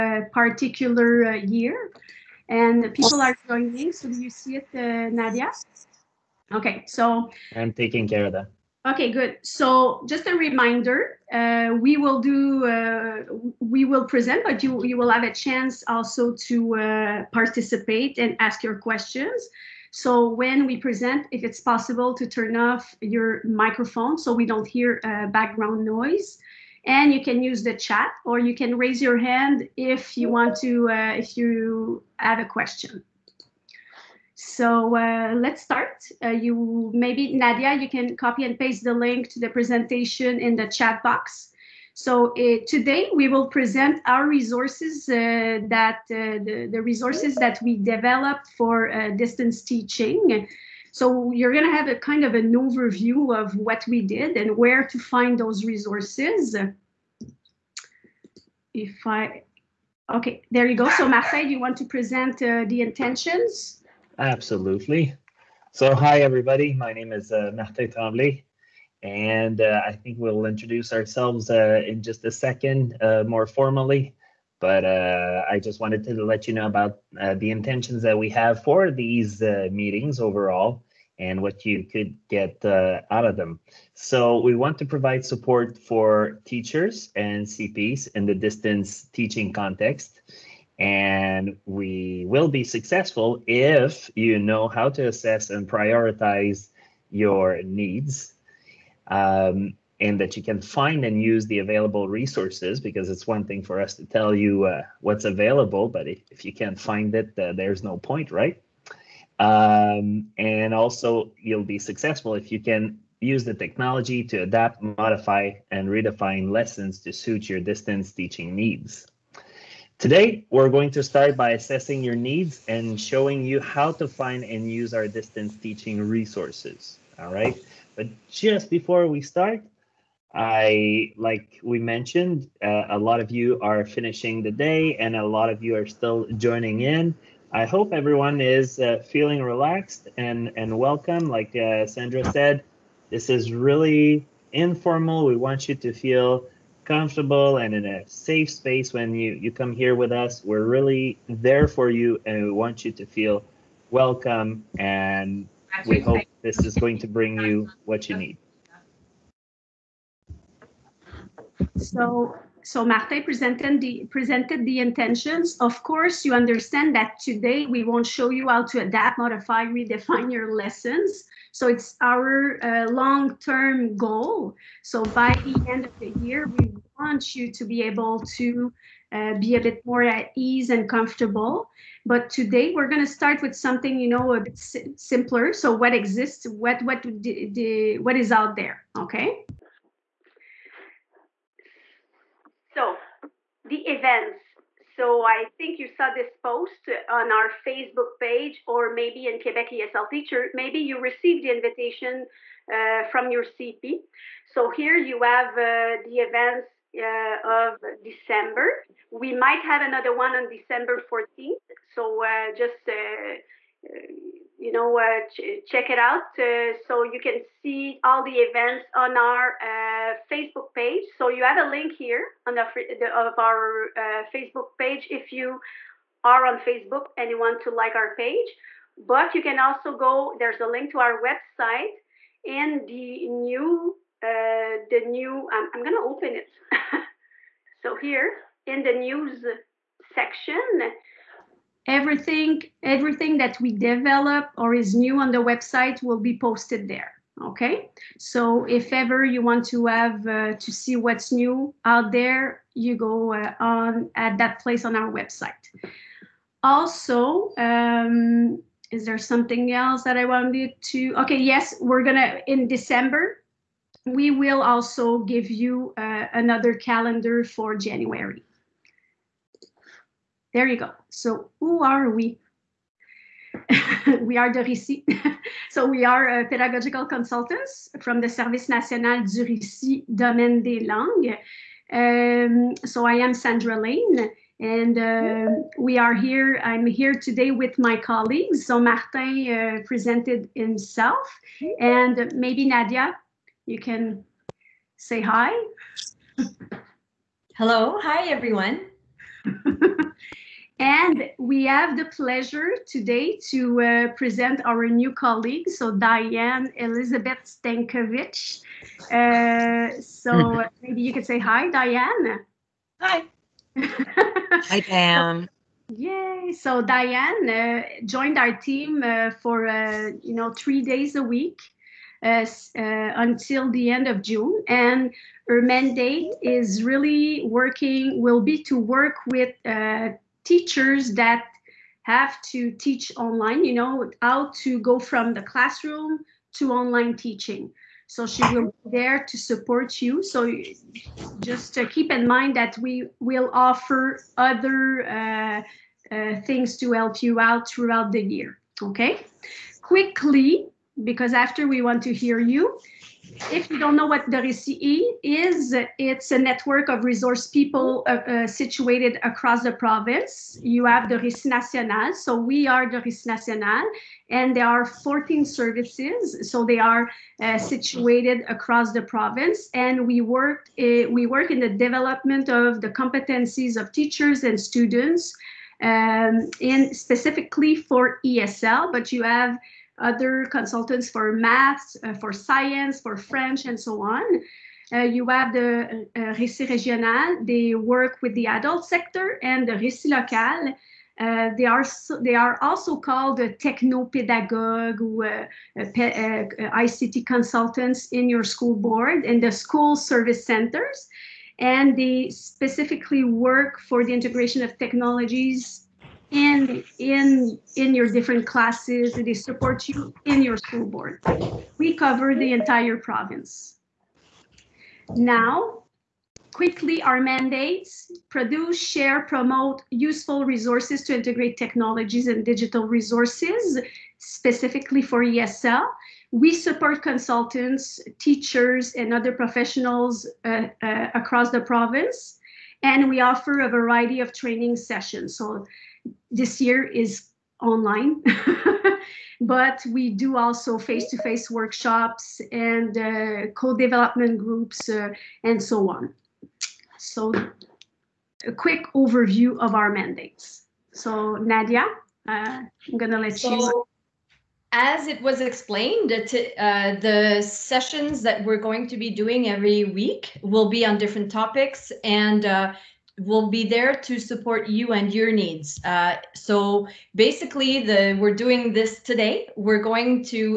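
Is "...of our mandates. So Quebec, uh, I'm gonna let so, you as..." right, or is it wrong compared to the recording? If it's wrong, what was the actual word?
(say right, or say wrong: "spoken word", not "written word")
wrong: "Nadia", not "Quebec".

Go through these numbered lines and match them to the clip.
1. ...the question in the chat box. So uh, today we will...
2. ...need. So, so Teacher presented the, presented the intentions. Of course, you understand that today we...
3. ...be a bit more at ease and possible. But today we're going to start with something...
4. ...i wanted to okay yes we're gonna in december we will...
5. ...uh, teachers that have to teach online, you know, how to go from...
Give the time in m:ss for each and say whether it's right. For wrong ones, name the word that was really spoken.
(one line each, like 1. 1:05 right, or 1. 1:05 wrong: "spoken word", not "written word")
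1. 0:39 wrong: "presentation", not "question"
2. 2:38 wrong: "Marte", not "Teacher"
3. 2:59 wrong: "comfortable", not "possible"
4. 4:20 right
5. 5:29 right.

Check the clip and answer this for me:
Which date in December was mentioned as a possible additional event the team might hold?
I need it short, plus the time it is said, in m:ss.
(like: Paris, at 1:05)
December 14th, at 3:30.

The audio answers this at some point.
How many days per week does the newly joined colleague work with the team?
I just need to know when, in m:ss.
5:20.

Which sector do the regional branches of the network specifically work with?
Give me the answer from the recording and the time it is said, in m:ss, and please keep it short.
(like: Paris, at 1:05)
adult sector, at 6:28.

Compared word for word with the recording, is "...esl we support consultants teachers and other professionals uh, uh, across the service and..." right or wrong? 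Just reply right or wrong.
wrong.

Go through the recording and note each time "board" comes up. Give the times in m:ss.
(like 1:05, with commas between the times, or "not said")
6:38, 6:50.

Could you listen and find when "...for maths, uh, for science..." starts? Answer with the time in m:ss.
6:21.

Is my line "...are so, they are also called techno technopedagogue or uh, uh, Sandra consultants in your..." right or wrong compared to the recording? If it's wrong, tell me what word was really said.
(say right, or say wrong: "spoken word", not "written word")
wrong: "ICT", not "Sandra".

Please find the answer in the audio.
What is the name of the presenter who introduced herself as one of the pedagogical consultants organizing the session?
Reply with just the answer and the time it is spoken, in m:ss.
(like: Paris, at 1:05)
Sandra Lane, at 4:43.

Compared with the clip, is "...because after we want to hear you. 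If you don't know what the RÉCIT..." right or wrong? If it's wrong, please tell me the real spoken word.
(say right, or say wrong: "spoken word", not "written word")
right.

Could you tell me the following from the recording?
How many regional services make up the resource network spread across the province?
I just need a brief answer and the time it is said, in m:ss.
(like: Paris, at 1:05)
14, at 6:04.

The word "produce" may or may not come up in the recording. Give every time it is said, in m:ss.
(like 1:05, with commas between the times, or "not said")
6:58.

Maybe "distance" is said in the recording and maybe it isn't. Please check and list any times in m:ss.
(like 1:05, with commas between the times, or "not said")
0:49, 1:28, 1:57, 2:05.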